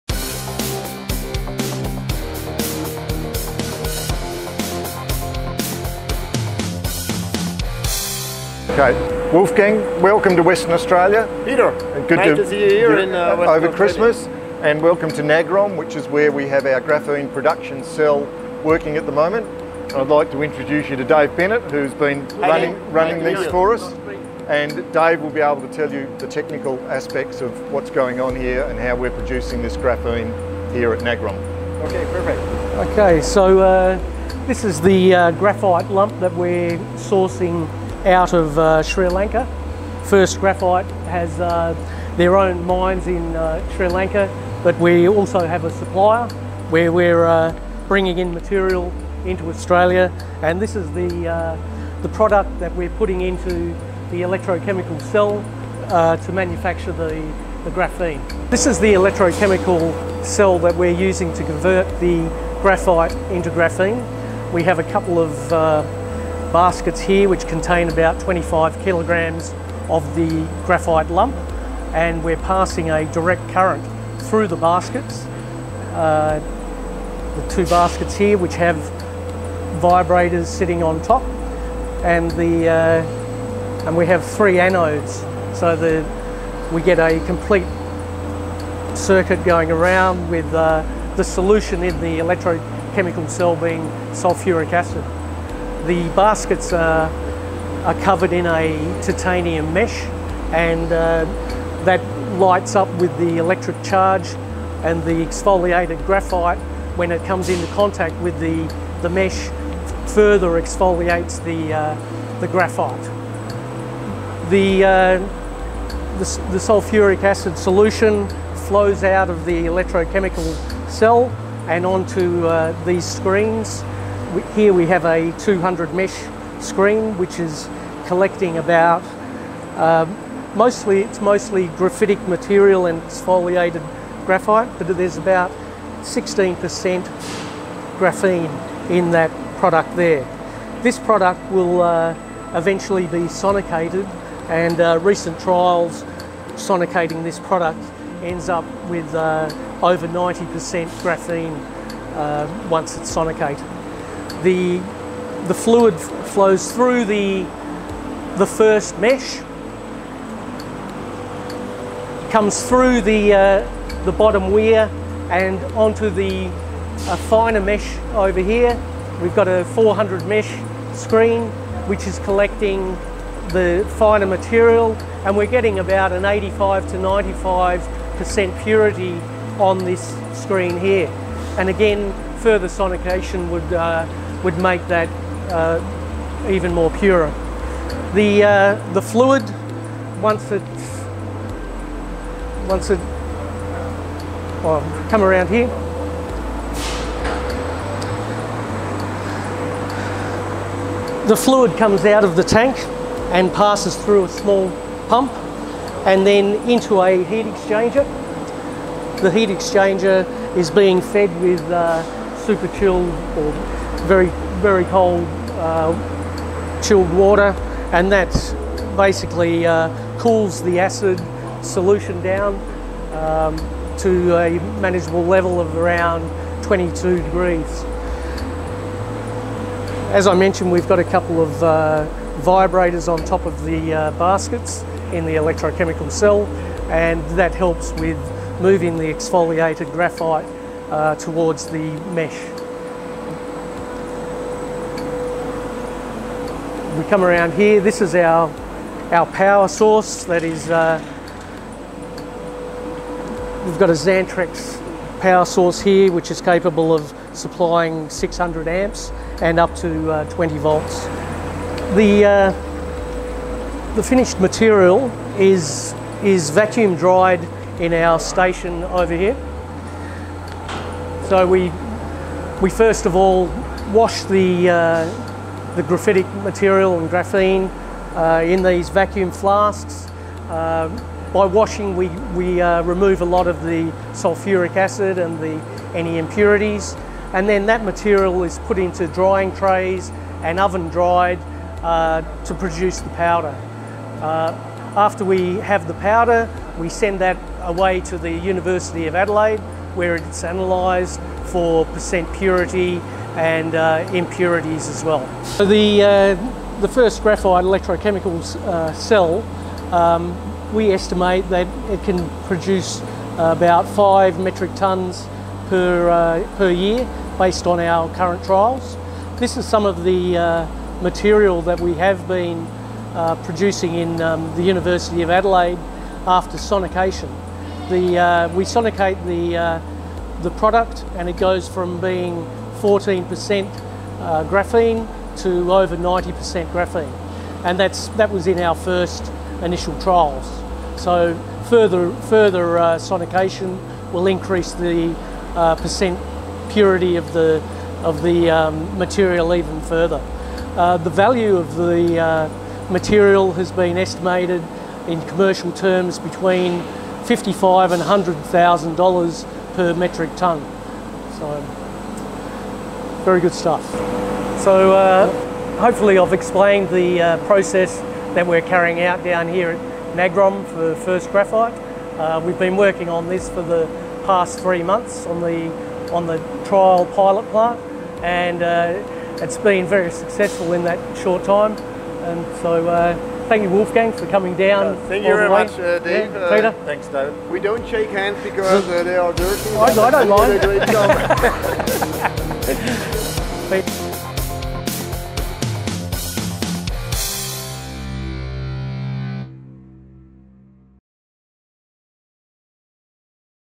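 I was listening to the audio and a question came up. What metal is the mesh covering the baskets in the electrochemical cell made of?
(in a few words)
titanium.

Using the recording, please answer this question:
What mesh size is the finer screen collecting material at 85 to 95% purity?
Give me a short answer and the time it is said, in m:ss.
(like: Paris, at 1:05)
400, at 2:49.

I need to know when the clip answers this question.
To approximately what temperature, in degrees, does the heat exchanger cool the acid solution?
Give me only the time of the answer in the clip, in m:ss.
3:46.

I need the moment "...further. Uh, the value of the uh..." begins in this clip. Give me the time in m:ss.
5:49.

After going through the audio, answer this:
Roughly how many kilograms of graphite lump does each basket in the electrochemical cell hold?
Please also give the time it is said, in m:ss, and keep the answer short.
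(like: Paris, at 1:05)
25, at 1:08.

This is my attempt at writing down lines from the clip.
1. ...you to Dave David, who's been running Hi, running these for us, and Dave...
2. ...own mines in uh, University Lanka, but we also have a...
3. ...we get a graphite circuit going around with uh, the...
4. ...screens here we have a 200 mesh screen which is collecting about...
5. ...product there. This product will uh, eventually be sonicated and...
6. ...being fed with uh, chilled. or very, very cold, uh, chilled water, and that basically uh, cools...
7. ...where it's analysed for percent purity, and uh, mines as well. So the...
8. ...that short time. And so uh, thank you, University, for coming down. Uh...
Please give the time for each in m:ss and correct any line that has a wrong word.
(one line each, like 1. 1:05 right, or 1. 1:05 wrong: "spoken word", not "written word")
1. 0:20 wrong: "Bennett", not "David"
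2. 0:42 wrong: "Sri", not "University"
3. 1:26 wrong: "complete", not "graphite"
4. 2:03 right
5. 2:19 right
6. 3:30 right
7. 4:59 wrong: "impurities", not "mines"
8. 6:20 wrong: "Wolfgang", not "University".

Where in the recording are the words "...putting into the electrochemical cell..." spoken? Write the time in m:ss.
0:52.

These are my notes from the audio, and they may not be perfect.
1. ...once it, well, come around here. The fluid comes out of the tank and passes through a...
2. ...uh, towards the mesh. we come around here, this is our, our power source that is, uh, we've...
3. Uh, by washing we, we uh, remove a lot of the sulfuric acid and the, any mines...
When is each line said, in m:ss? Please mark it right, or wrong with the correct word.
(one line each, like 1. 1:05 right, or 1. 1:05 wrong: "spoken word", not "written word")
1. 3:12 right
2. 4:00 right
3. 4:40 wrong: "impurities", not "mines".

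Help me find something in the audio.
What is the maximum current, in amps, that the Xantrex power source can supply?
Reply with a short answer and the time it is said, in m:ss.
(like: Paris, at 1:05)
600, at 4:18.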